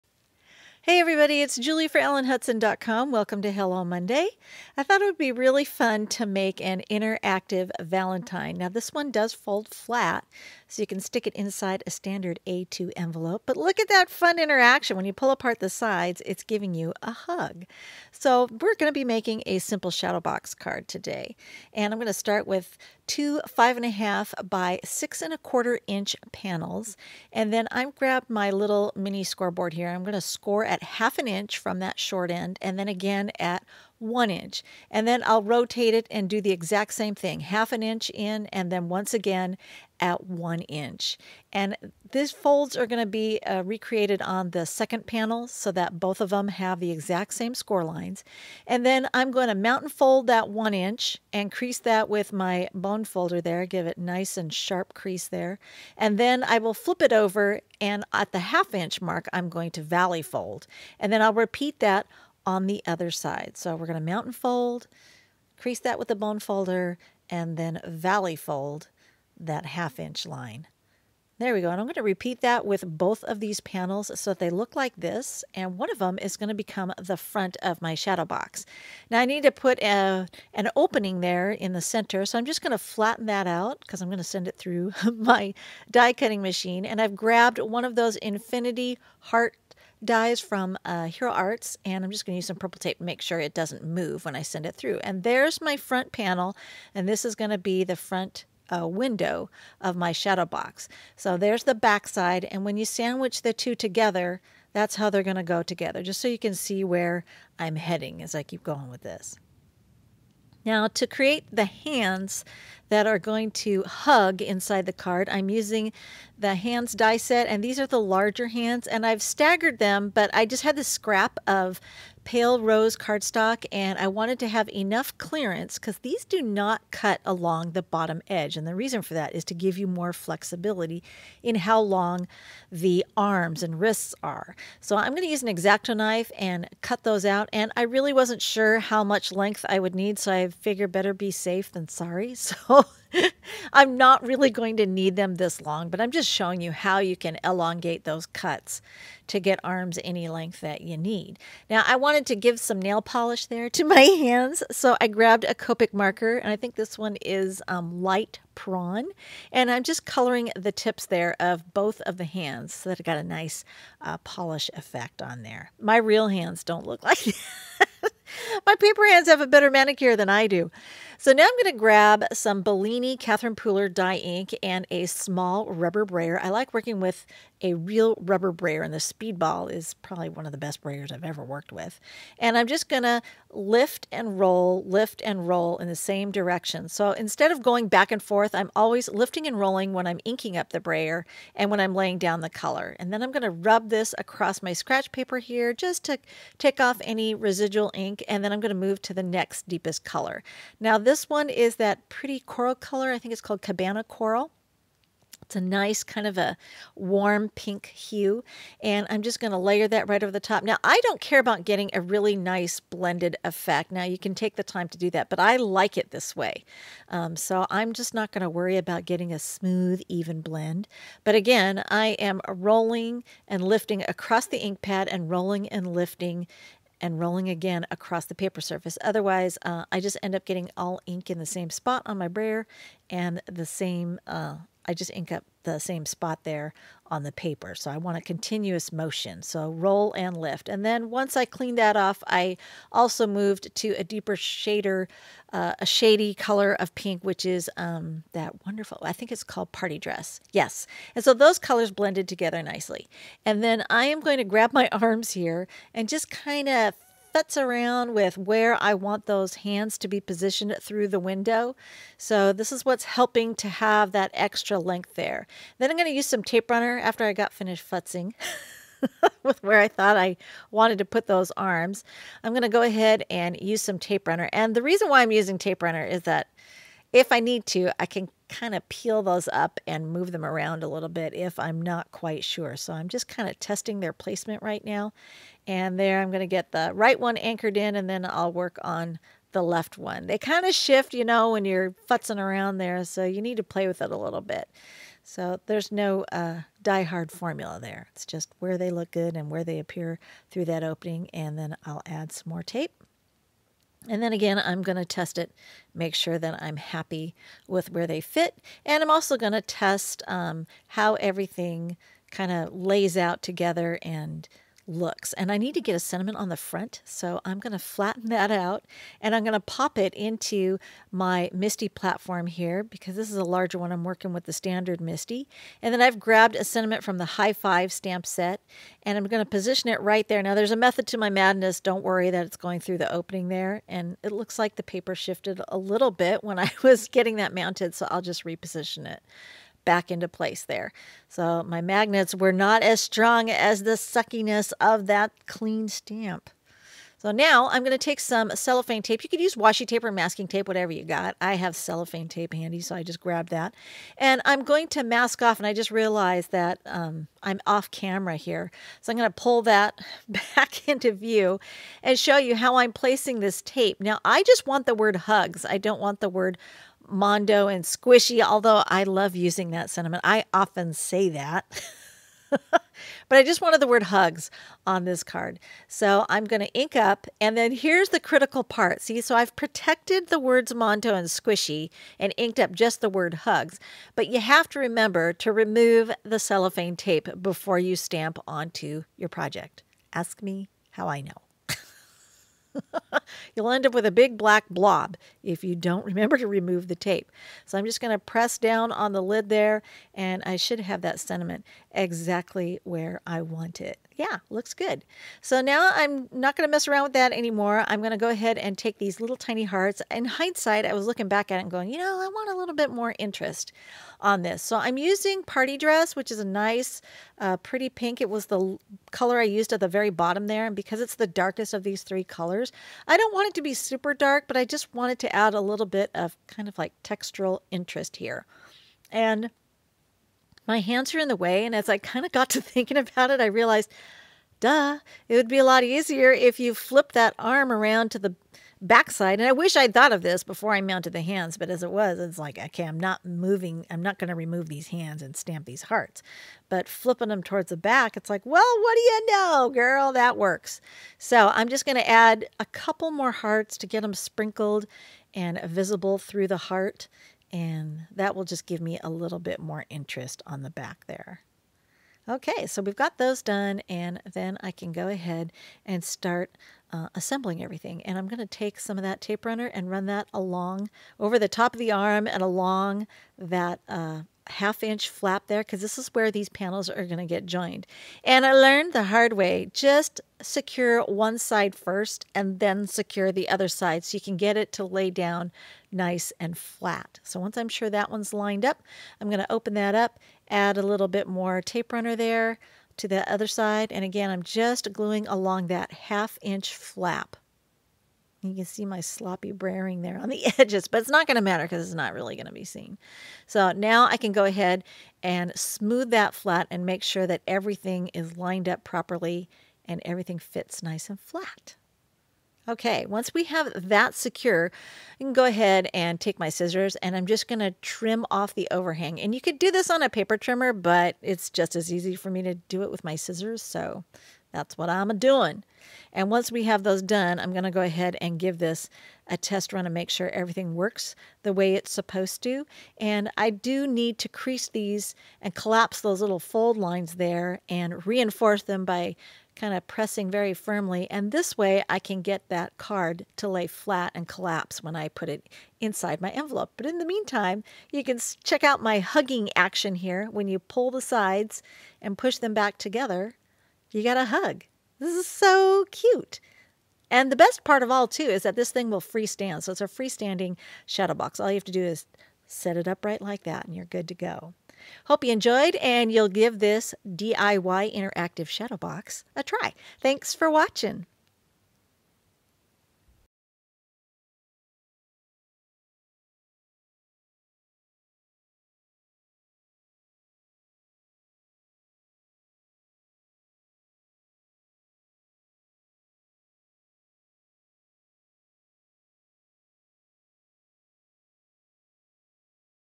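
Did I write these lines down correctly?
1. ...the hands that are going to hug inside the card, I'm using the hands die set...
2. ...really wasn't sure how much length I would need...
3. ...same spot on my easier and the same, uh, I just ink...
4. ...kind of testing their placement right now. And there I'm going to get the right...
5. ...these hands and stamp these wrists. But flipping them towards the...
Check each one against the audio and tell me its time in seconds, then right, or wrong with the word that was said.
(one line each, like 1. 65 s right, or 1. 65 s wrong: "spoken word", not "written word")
1. 111 s right
2. 137 s right
3. 231 s wrong: "brayer", not "easier"
4. 283 s right
5. 444 s wrong: "hearts", not "wrists".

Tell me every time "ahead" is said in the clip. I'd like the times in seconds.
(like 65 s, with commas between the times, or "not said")
272 s, 408 s, 465 s, 504 s, 515 s, 527 s.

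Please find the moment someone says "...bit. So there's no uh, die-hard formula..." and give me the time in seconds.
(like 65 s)
294 s.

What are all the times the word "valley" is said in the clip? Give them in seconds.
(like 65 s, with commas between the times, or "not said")
59 s, 67 s.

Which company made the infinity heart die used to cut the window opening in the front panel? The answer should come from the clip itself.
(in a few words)
Hero Arts.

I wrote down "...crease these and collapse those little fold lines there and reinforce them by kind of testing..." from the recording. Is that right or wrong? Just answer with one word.
wrong.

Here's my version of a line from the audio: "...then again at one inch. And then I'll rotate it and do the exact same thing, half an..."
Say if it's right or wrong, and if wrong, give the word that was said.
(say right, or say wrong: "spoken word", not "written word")
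right.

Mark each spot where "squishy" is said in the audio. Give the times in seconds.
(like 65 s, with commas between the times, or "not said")
367 s, 381 s.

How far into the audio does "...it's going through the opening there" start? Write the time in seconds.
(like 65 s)
332 s.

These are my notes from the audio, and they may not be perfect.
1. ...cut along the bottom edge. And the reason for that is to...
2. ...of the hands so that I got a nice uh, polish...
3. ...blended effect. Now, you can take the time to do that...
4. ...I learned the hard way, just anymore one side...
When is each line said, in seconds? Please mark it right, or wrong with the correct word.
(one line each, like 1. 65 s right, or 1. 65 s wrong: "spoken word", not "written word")
1. 126 s right
2. 162 s right
3. 212 s right
4. 478 s wrong: "secure", not "anymore".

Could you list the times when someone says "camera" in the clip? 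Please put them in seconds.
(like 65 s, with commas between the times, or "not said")
357 s.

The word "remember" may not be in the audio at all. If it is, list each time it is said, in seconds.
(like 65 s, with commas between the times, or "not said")
384 s, 396 s.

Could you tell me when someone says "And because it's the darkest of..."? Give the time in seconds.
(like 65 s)
420 s.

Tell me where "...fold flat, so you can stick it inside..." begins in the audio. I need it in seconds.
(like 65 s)
9 s.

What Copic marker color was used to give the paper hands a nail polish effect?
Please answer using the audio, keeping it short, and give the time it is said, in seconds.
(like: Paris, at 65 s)
light prawn, at 158 s.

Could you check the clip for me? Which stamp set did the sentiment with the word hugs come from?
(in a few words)
High Five.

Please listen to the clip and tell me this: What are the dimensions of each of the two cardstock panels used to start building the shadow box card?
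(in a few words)
5.5 by 6.25 inches.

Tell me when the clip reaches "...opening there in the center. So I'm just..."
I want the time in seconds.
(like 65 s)
80 s.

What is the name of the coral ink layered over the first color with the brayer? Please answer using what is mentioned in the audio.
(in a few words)
Cabana Coral.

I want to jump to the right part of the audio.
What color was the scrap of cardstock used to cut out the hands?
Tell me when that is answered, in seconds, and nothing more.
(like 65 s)
122 s.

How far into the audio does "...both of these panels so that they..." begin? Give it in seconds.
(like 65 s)
72 s.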